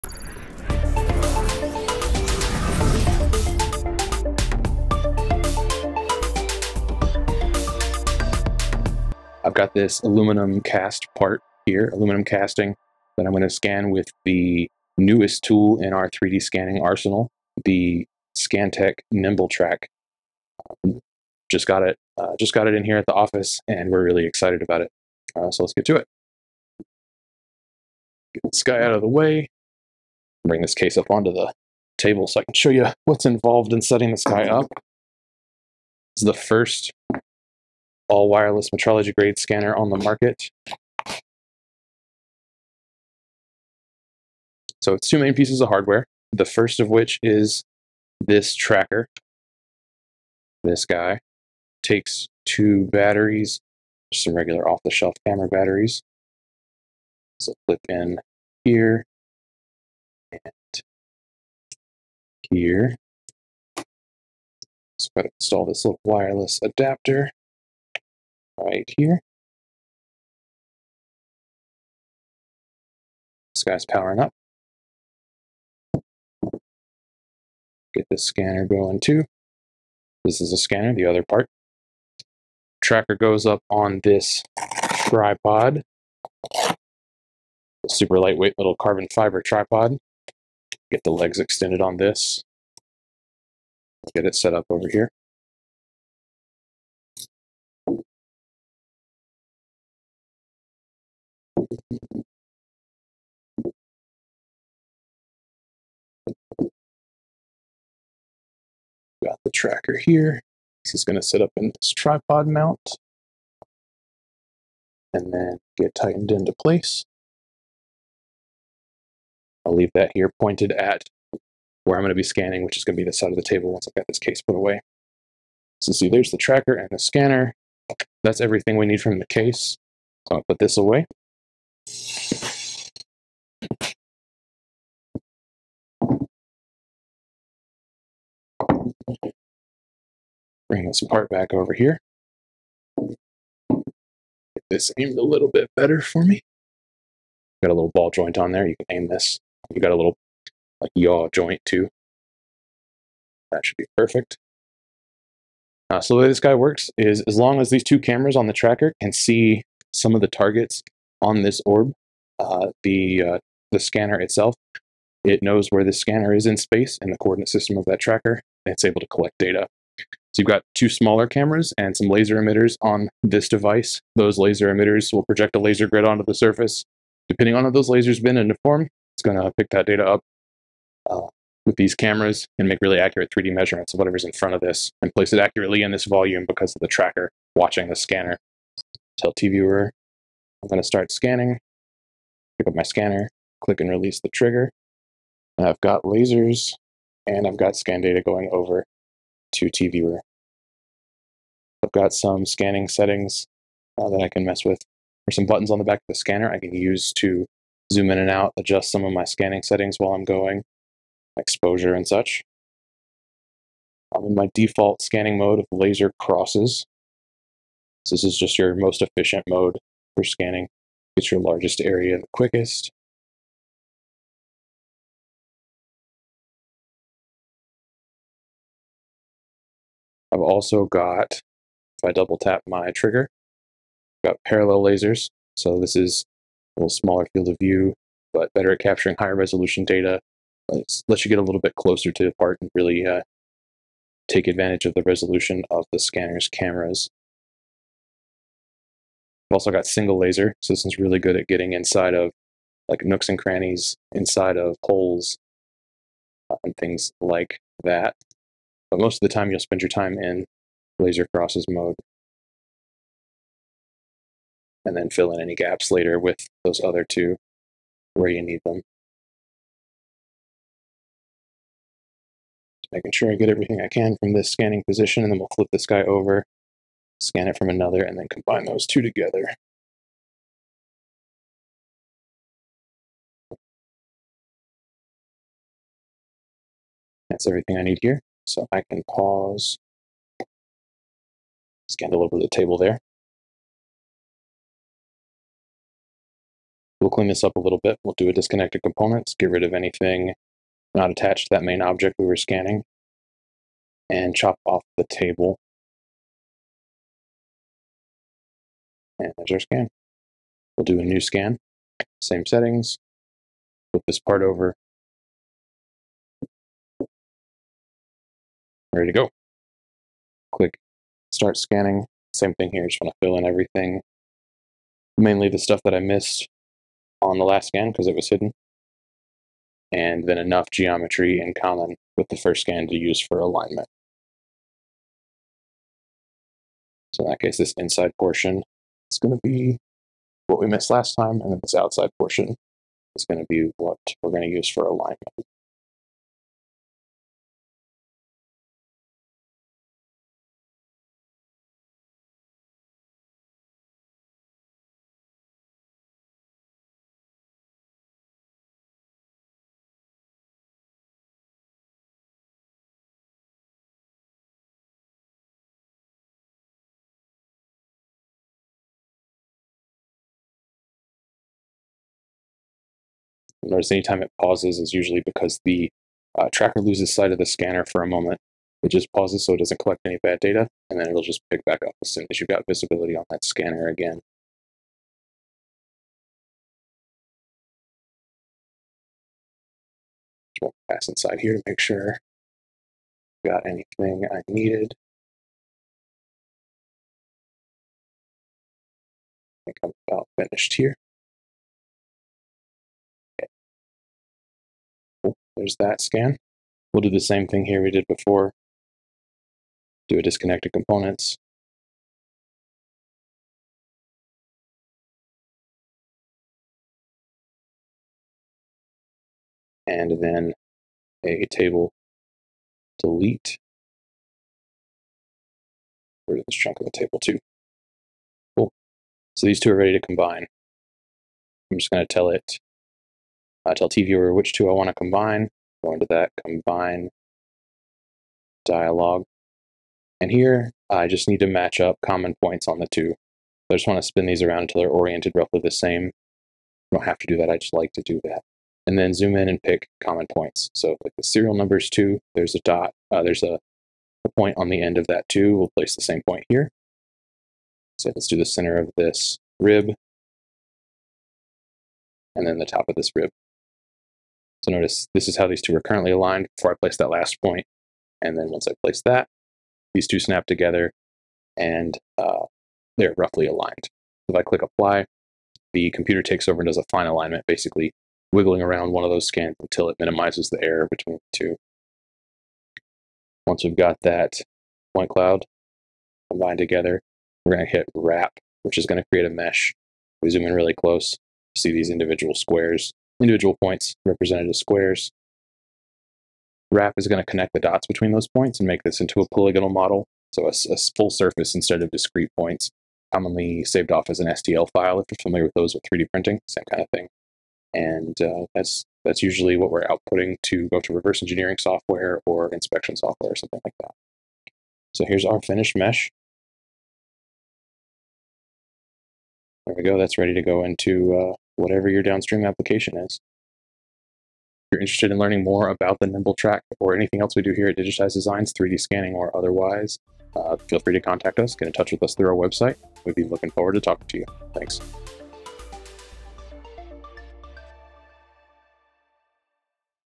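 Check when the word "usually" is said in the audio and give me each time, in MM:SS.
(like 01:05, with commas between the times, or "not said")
06:14, 08:29.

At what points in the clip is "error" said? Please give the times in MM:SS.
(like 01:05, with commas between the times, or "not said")
08:00.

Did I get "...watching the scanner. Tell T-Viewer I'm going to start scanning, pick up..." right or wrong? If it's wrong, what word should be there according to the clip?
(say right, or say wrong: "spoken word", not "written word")
right.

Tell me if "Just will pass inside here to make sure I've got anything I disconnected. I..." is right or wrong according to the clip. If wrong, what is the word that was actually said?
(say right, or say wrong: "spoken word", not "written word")
wrong: "needed", not "disconnected".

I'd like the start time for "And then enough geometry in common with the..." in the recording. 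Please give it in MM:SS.
05:29.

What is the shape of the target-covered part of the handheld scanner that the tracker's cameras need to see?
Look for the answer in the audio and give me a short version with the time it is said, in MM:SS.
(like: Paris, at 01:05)
orb, at 02:41.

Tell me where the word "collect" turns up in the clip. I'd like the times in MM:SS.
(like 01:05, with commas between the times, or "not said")
02:49, 06:19.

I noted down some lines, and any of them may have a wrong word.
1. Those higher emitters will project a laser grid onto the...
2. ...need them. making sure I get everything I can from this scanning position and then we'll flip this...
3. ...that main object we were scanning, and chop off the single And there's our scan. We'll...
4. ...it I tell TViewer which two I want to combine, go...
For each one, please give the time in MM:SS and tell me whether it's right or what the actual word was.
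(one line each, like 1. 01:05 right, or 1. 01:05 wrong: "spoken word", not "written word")
1. 02:54 wrong: "laser", not "higher"
2. 04:28 right
3. 05:01 wrong: "table", not "single"
4. 07:12 right.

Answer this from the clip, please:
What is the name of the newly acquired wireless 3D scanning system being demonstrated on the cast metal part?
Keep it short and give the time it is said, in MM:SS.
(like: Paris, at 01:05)
Scantech Nimble Track, at 00:18.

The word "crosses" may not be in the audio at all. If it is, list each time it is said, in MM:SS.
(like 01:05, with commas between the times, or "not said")
03:36, 04:21.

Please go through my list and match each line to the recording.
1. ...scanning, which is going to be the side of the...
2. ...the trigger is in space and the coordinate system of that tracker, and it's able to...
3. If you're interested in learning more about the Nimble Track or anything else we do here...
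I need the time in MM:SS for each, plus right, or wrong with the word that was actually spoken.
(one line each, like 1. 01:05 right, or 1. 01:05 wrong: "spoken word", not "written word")
1. 02:02 right
2. 02:45 wrong: "scanner", not "trigger"
3. 08:44 right.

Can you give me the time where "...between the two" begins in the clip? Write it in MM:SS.
08:00.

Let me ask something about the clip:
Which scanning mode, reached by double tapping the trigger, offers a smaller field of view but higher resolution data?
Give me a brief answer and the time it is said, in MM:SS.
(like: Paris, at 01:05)
parallel lasers, at 03:54.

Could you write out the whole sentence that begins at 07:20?
And here I just need to match up common points on the two.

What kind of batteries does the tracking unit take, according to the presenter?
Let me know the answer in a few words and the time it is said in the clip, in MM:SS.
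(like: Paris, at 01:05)
camera batteries, at 00:55.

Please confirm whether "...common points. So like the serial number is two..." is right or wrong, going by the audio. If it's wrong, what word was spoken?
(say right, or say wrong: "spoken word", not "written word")
right.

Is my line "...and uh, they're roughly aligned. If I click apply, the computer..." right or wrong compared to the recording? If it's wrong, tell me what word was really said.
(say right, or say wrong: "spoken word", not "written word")
right.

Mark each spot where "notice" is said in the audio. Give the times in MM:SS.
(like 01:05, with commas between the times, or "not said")
06:13, 07:44.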